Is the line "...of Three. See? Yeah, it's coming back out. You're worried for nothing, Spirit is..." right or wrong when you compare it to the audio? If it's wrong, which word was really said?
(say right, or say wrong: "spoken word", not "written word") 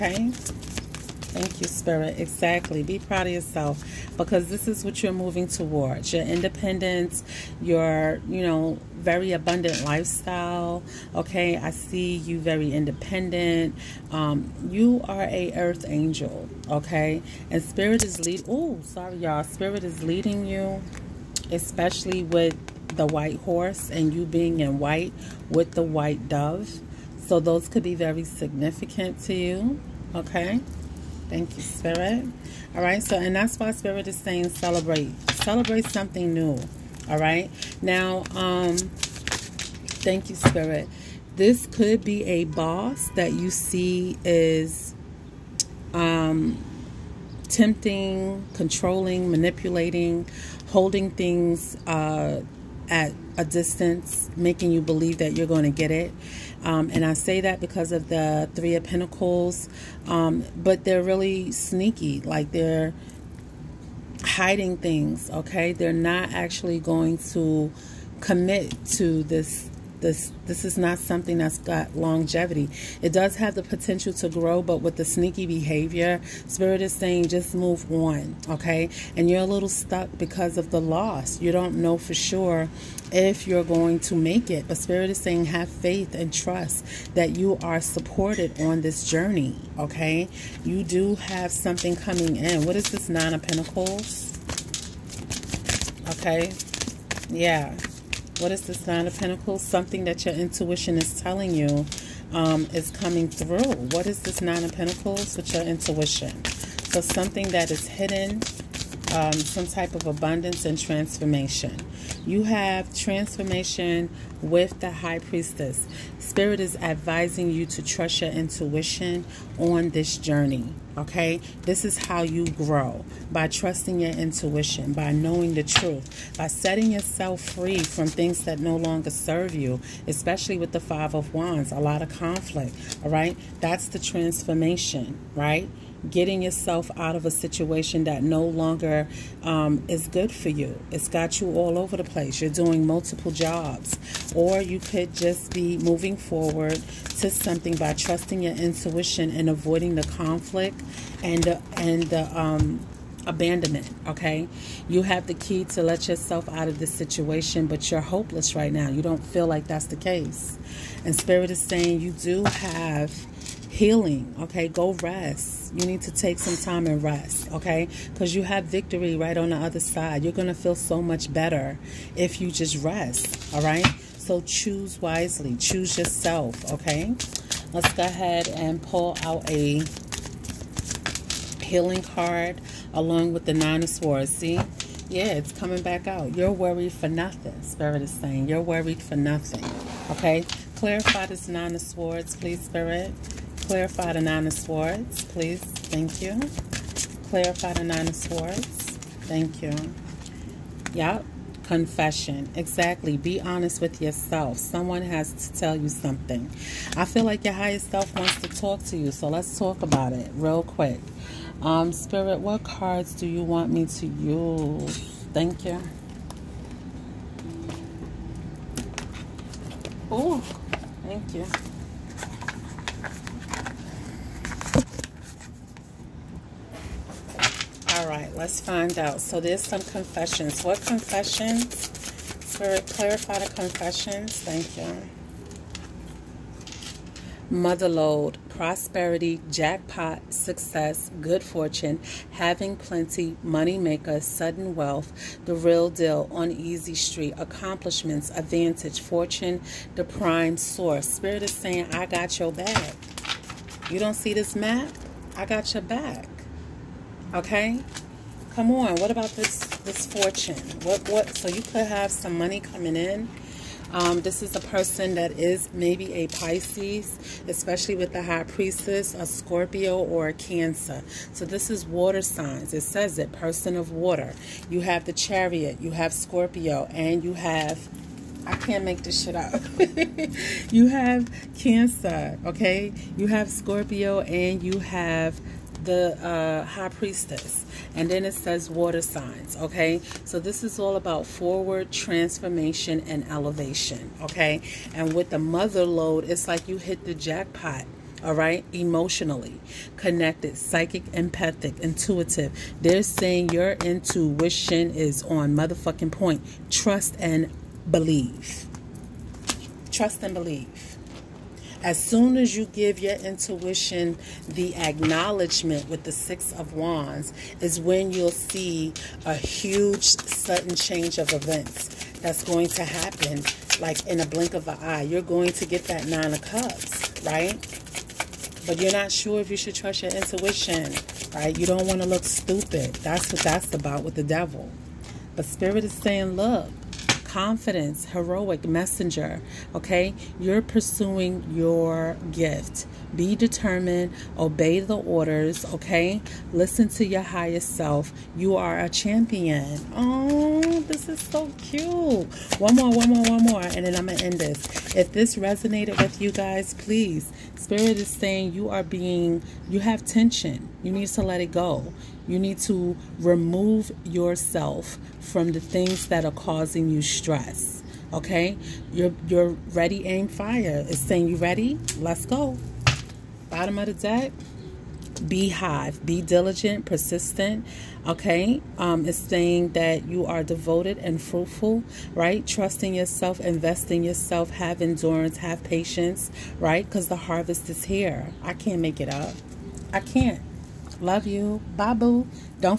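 wrong: "Swords", not "Three".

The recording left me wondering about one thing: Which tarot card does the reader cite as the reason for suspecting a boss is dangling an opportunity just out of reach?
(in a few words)
Three of Pentacles.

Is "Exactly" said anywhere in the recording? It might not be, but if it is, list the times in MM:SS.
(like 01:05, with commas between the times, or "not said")
00:02, 03:22.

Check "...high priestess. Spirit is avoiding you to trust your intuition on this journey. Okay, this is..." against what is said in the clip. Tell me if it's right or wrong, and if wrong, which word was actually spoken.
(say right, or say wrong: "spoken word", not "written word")
wrong: "advising", not "avoiding".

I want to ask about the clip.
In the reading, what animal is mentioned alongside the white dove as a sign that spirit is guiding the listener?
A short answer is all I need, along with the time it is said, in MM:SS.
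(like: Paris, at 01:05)
White horse, at 00:23.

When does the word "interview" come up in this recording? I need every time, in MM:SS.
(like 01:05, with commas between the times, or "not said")
not said.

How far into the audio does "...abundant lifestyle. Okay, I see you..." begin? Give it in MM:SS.
00:09.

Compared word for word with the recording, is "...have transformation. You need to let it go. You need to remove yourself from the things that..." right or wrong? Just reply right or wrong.
wrong.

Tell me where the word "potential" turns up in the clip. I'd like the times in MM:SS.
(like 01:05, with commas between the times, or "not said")
01:13.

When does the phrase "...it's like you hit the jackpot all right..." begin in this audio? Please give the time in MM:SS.
04:56.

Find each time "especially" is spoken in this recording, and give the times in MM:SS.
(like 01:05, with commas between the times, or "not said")
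00:21, 02:10, 04:27.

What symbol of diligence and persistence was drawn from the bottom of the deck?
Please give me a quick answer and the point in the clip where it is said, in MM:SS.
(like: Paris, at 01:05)
Beehive, at 06:15.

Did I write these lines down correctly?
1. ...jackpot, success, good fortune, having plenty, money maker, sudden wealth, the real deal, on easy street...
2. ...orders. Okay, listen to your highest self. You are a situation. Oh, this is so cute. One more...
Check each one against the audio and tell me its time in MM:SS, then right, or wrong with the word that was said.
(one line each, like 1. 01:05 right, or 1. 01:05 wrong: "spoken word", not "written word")
1. 03:59 right
2. 05:44 wrong: "champion", not "situation".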